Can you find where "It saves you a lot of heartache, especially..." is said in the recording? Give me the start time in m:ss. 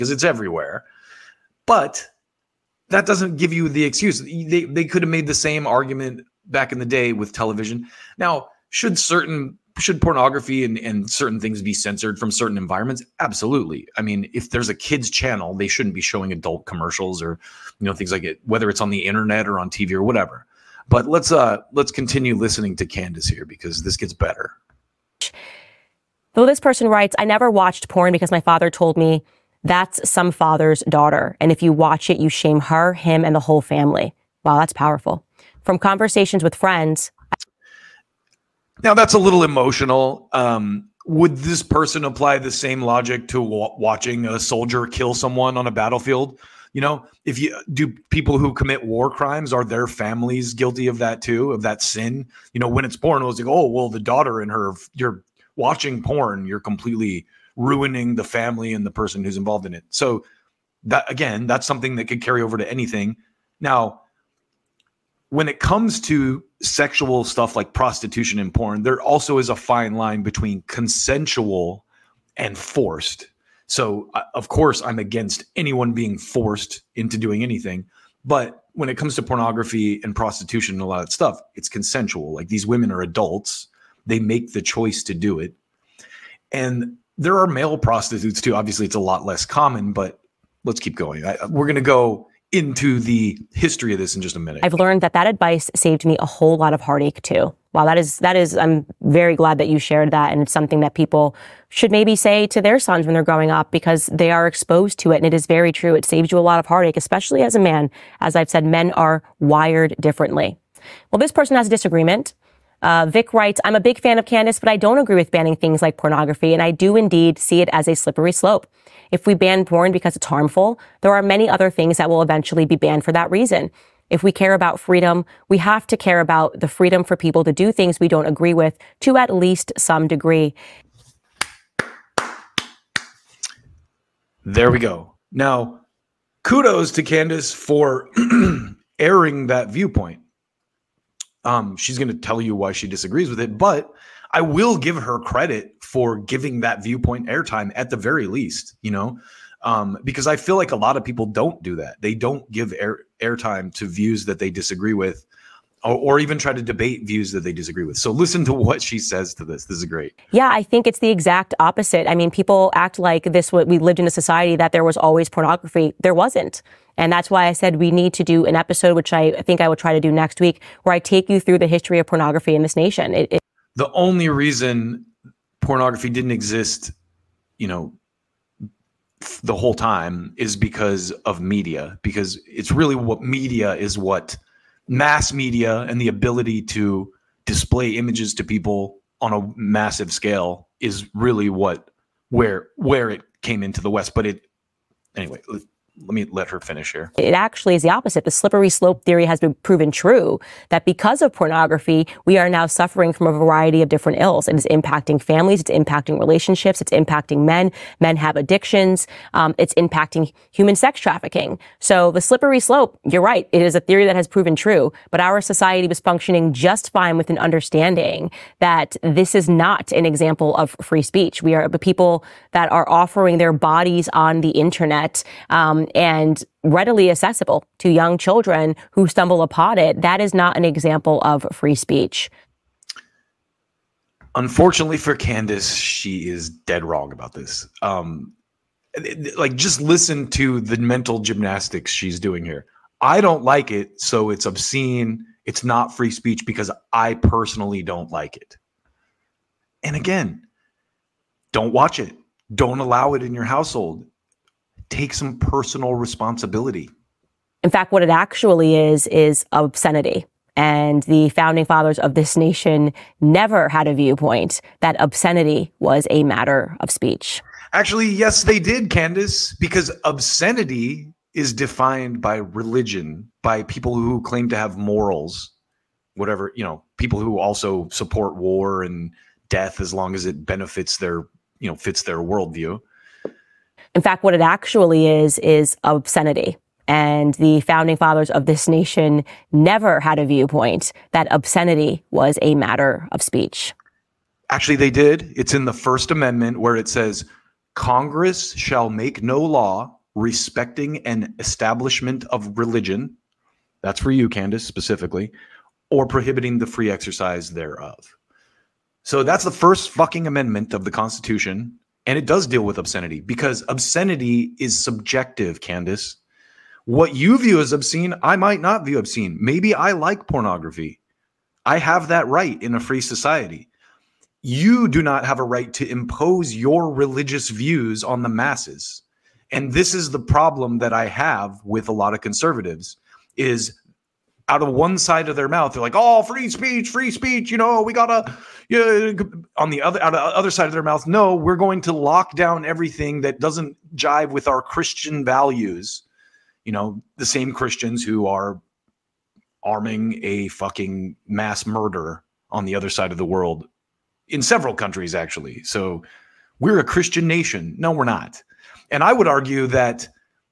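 1:45.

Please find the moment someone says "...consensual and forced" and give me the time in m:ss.
1:10.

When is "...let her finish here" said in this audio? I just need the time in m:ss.
3:16.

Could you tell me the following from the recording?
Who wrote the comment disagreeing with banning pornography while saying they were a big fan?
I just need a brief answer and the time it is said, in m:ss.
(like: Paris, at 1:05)
Vic, at 1:53.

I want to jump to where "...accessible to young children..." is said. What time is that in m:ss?
3:47.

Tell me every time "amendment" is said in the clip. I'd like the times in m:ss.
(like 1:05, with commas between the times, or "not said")
4:56, 5:10.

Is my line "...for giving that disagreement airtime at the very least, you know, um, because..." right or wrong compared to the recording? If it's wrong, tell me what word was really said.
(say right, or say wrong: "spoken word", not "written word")
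wrong: "viewpoint", not "disagreement".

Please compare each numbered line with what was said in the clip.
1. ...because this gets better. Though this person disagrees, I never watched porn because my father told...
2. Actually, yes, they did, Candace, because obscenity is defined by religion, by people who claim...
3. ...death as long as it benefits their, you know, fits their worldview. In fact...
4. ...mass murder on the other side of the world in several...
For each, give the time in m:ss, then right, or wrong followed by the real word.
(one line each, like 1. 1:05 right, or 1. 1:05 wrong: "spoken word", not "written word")
1. 0:23 wrong: "writes", not "disagrees"
2. 4:27 right
3. 4:39 right
4. 5:51 right.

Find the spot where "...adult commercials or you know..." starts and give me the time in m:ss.
0:16.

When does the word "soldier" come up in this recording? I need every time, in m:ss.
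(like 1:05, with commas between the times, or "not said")
0:44.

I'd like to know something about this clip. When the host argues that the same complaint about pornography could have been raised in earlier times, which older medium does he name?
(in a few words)
television.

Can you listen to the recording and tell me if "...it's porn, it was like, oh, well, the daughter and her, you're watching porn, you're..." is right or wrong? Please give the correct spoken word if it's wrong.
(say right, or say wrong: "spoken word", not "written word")
right.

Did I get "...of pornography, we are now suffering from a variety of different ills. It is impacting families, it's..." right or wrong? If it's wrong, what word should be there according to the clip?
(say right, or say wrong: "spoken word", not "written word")
right.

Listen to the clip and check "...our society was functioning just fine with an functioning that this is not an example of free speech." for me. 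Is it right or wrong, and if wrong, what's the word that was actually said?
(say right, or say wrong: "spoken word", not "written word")
wrong: "understanding", not "functioning".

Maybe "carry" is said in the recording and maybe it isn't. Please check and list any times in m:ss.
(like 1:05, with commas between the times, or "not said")
1:02.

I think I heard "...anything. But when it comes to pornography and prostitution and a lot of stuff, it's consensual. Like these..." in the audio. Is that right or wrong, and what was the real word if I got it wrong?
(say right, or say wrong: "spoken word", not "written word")
right.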